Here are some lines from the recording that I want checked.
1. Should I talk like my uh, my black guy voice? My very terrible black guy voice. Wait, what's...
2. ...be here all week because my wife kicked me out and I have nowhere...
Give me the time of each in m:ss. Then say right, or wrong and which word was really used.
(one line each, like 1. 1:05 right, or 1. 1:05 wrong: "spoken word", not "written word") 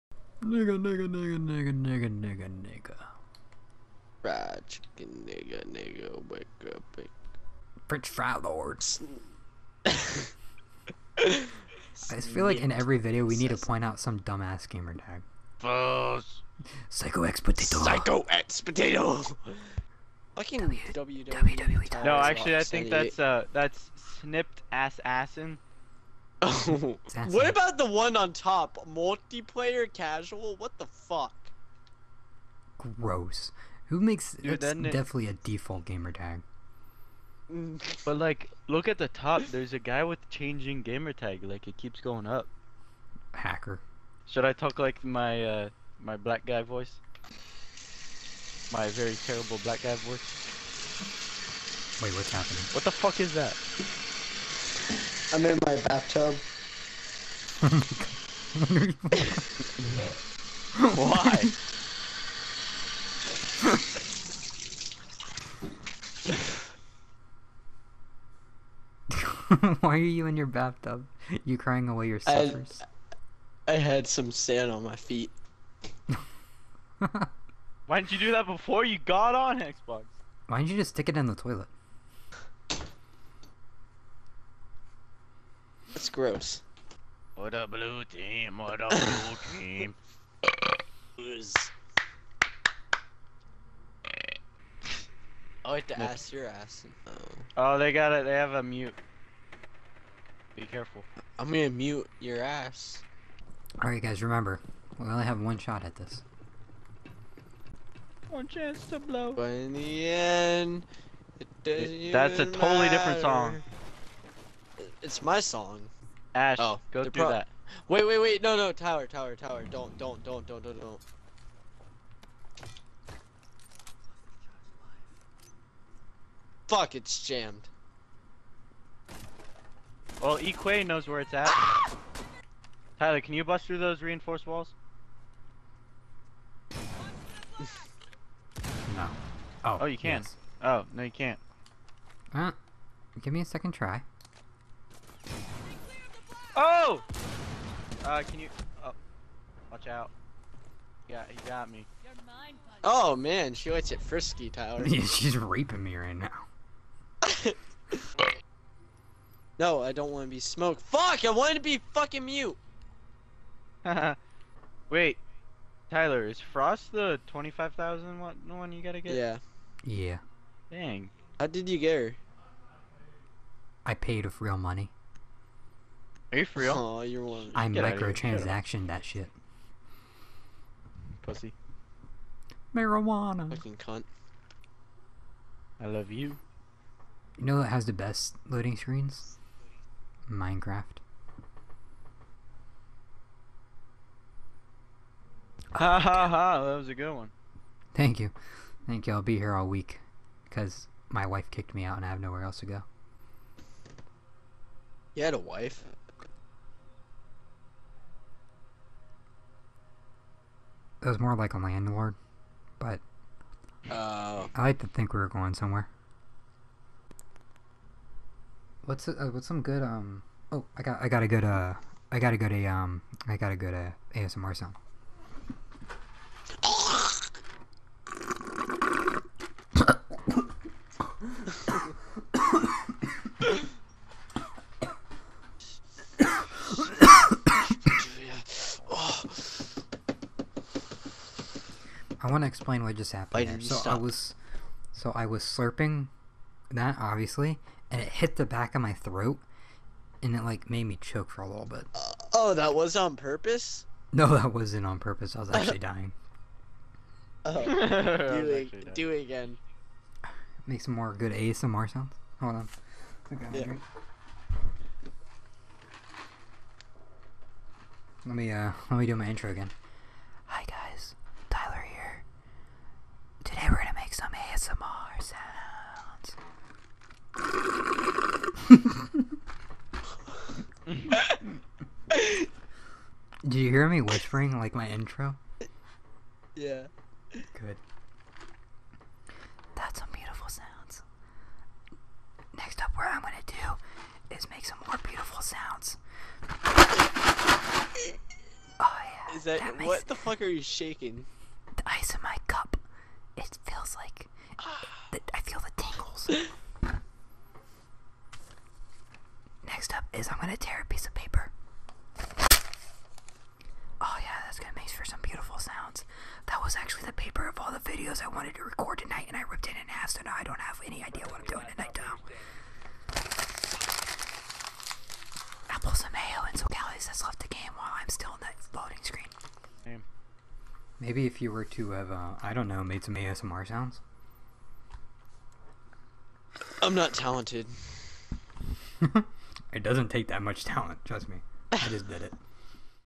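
1. 0:44 right
2. 3:19 right.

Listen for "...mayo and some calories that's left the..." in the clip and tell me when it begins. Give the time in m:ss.
5:26.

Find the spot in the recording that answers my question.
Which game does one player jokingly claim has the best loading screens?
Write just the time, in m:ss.
3:10.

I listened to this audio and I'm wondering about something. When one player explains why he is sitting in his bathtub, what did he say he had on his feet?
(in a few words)
Sand.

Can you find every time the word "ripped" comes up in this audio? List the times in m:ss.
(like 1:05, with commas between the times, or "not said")
5:19.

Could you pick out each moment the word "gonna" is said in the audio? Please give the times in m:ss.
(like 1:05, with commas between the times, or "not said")
1:41, 4:53, 5:10, 5:14.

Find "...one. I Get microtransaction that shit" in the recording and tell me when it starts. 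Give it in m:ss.
2:57.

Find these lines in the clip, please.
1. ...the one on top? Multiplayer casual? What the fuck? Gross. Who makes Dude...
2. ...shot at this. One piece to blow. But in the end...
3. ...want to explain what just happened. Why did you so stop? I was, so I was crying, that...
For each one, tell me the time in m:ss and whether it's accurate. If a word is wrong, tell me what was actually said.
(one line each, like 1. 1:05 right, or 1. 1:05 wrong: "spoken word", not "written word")
1. 0:27 right
2. 1:45 wrong: "chance", not "piece"
3. 4:02 wrong: "slurping", not "crying".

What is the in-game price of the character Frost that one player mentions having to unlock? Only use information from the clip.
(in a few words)
25,000.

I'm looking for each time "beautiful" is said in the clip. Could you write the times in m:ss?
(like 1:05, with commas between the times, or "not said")
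4:50, 4:55, 5:15.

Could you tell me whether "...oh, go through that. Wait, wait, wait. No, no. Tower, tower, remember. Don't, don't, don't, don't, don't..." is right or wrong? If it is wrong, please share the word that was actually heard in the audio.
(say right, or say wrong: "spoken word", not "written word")
wrong: "tower", not "remember".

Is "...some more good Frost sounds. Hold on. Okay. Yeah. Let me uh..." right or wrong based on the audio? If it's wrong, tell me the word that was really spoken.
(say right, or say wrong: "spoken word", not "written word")
wrong: "ASMR", not "Frost".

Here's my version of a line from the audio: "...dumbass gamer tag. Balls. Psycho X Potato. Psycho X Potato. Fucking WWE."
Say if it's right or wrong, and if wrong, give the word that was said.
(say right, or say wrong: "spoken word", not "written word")
right.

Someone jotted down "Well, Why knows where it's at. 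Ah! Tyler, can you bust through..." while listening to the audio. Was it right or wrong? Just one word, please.
wrong.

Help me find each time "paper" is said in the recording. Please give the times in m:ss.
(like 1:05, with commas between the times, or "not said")
5:11, 5:17.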